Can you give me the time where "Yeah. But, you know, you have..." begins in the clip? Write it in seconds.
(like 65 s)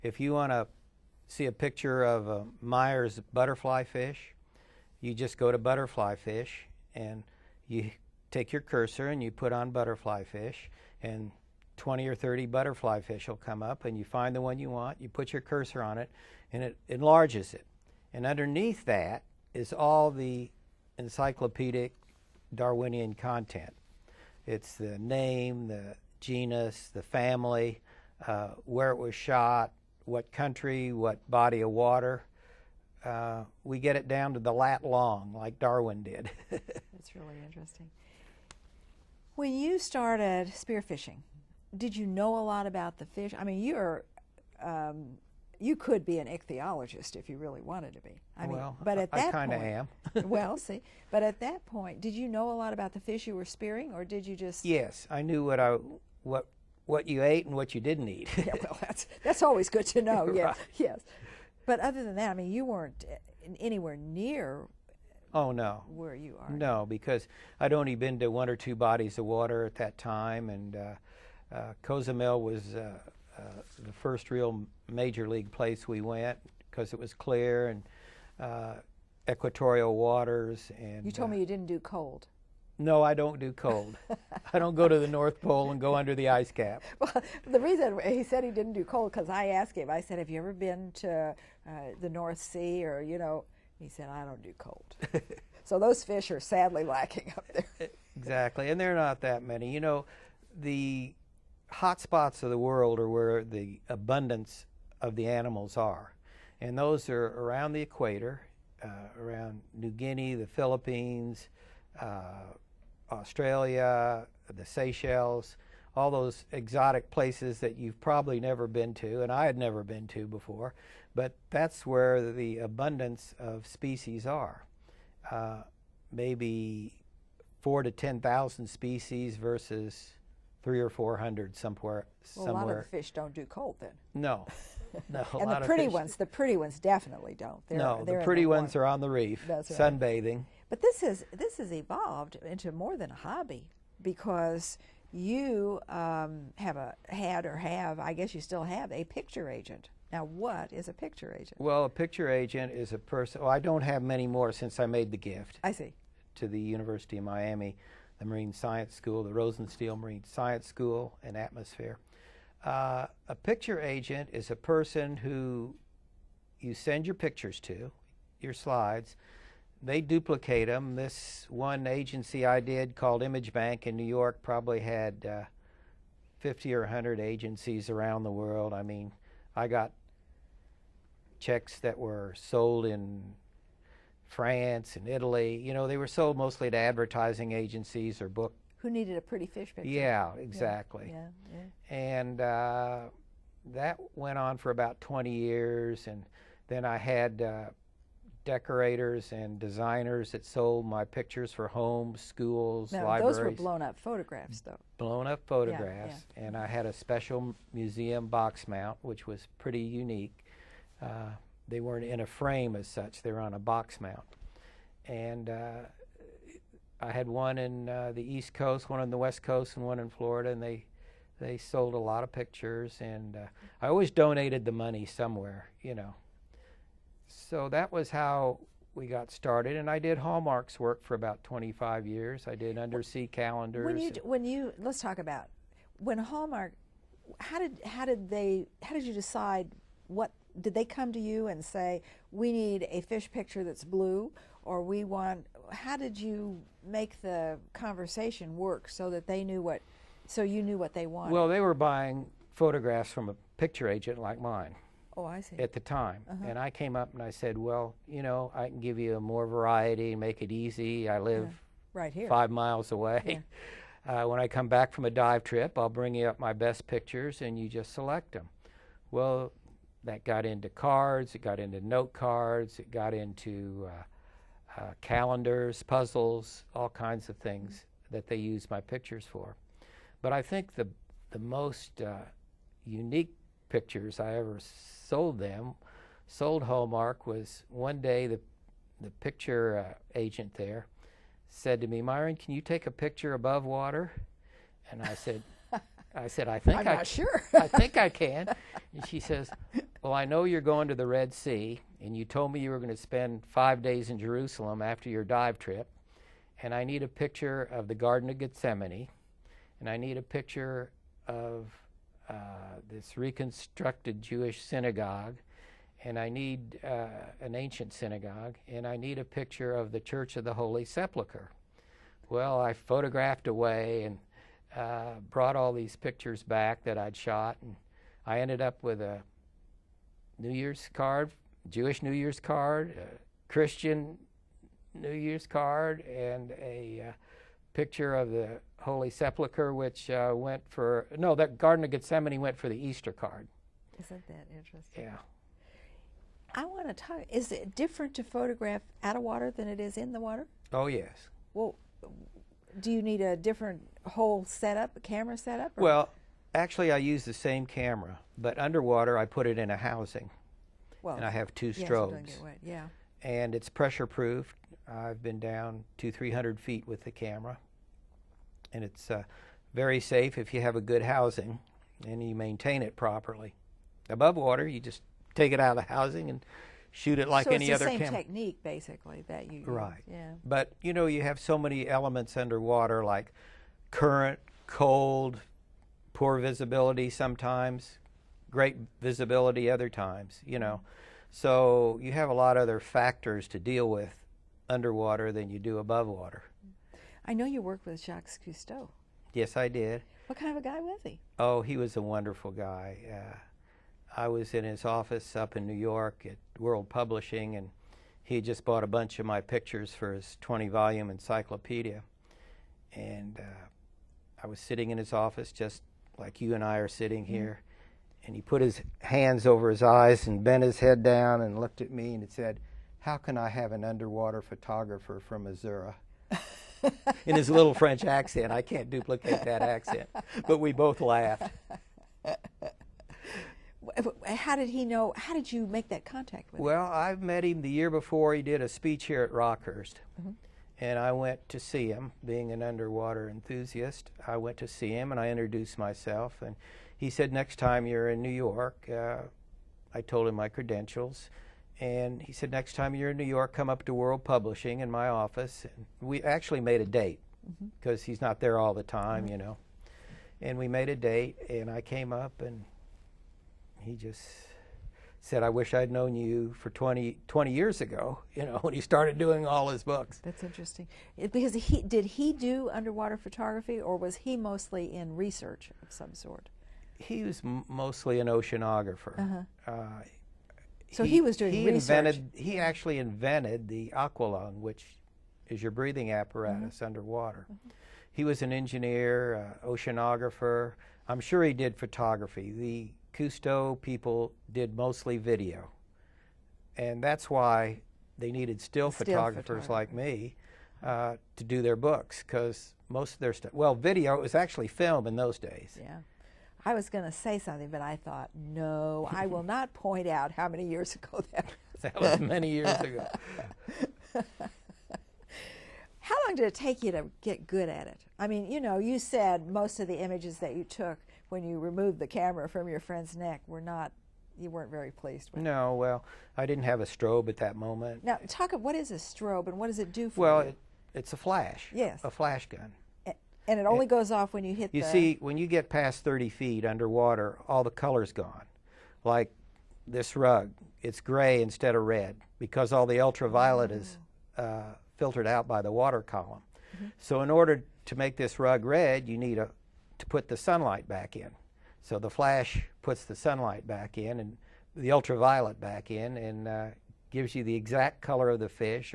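380 s.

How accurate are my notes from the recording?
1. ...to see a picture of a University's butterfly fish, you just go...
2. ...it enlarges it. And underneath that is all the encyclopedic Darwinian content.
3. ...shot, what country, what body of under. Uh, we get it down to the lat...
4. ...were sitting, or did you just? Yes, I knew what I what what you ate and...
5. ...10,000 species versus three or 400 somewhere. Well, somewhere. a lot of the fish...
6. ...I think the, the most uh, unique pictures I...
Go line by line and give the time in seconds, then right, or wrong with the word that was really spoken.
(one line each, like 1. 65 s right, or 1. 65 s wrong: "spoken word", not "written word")
1. 0 s wrong: "Meyer", not "University"
2. 16 s right
3. 29 s wrong: "water", not "under"
4. 53 s wrong: "spearing", not "sitting"
5. 127 s right
6. 280 s right.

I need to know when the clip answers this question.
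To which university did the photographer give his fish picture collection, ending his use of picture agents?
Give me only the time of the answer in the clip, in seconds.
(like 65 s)
156 s.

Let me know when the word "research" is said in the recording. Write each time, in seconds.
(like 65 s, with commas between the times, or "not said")
475 s, 481 s.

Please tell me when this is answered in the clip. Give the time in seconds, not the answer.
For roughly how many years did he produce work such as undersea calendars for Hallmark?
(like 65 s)
231 s.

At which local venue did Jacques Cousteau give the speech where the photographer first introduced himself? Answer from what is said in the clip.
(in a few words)
Rockhurst.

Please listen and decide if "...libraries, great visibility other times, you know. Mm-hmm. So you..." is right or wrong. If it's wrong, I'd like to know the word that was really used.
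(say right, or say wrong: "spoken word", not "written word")
wrong: "sometimes", not "libraries".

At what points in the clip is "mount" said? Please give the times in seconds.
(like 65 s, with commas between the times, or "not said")
208 s, 213 s.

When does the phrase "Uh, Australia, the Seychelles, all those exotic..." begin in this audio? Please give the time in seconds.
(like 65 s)
111 s.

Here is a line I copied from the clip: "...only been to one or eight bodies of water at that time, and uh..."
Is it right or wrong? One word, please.
wrong.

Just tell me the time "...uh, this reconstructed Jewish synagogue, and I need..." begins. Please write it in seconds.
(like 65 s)
312 s.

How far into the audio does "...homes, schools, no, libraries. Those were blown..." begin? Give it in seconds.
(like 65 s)
201 s.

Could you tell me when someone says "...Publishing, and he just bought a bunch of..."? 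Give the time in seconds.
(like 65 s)
406 s.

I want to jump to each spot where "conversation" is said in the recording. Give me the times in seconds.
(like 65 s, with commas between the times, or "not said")
247 s.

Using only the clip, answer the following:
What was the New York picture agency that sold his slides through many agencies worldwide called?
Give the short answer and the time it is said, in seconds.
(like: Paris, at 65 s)
Image Bank, at 173 s.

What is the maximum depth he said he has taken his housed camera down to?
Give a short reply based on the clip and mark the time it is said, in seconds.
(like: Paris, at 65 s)
300 feet, at 366 s.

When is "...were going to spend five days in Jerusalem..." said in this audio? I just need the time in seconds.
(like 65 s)
302 s.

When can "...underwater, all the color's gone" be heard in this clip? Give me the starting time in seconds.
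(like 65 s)
536 s.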